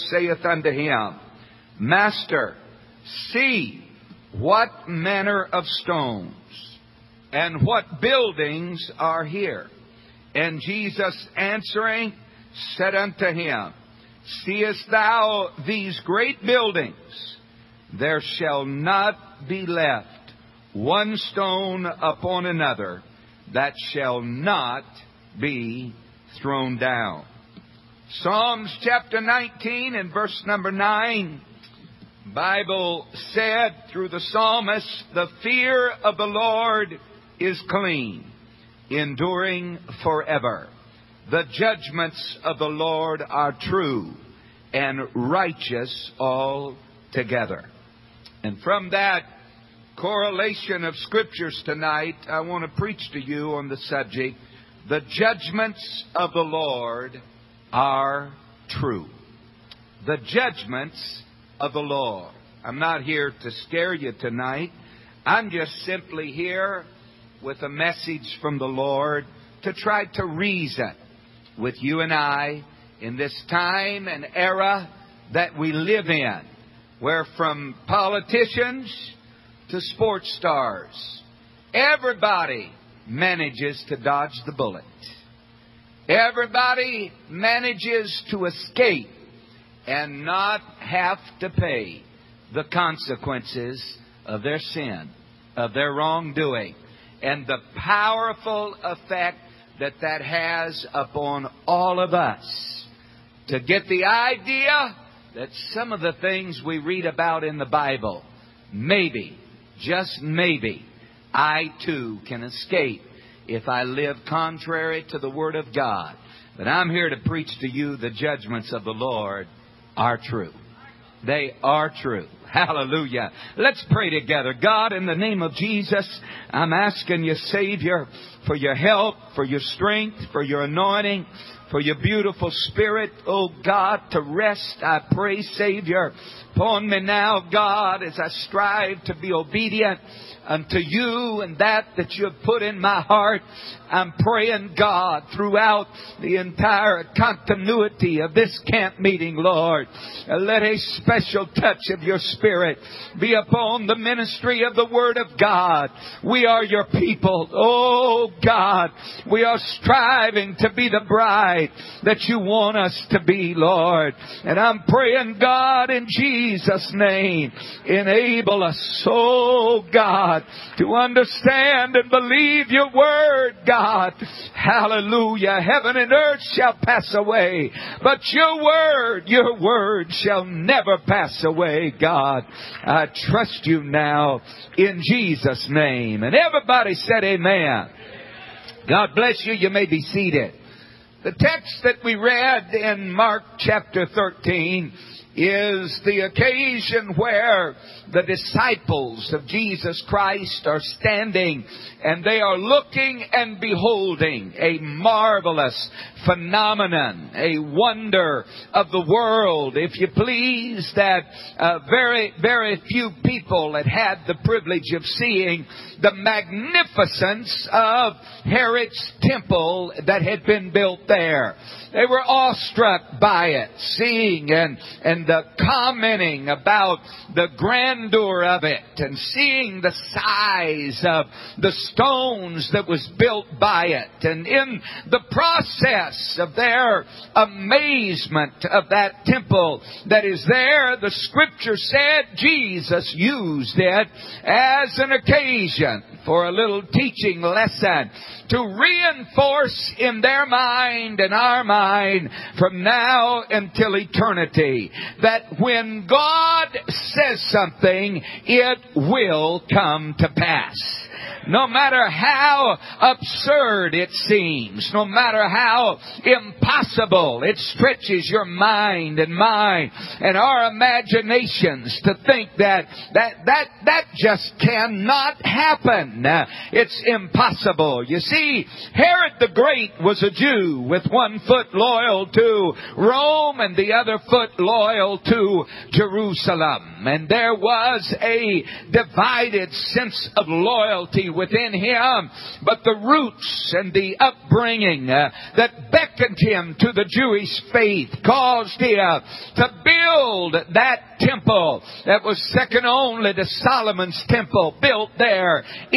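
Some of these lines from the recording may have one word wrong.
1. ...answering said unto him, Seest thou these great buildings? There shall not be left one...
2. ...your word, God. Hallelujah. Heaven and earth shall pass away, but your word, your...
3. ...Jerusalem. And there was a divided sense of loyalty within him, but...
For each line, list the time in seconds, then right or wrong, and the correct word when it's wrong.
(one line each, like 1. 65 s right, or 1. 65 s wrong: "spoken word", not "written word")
1. 11 s right
2. 172 s right
3. 285 s right.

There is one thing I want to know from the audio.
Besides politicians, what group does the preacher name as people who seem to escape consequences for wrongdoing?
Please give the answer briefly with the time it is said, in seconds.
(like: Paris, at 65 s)
sports stars, at 79 s.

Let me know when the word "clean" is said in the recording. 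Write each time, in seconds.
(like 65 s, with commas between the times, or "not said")
37 s.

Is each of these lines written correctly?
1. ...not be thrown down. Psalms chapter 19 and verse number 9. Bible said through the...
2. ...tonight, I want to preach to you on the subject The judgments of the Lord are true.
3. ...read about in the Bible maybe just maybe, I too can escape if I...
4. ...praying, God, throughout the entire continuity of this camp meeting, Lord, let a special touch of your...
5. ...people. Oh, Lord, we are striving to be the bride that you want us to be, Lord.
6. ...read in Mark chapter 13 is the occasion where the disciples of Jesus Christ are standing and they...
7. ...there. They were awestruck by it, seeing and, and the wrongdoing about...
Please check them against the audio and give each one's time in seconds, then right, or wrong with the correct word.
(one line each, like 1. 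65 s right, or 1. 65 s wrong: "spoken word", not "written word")
1. 24 s right
2. 51 s right
3. 106 s right
4. 144 s right
5. 156 s wrong: "God", not "Lord"
6. 192 s right
7. 221 s wrong: "commenting", not "wrongdoing".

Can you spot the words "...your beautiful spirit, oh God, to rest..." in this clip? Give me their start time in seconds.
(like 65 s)
131 s.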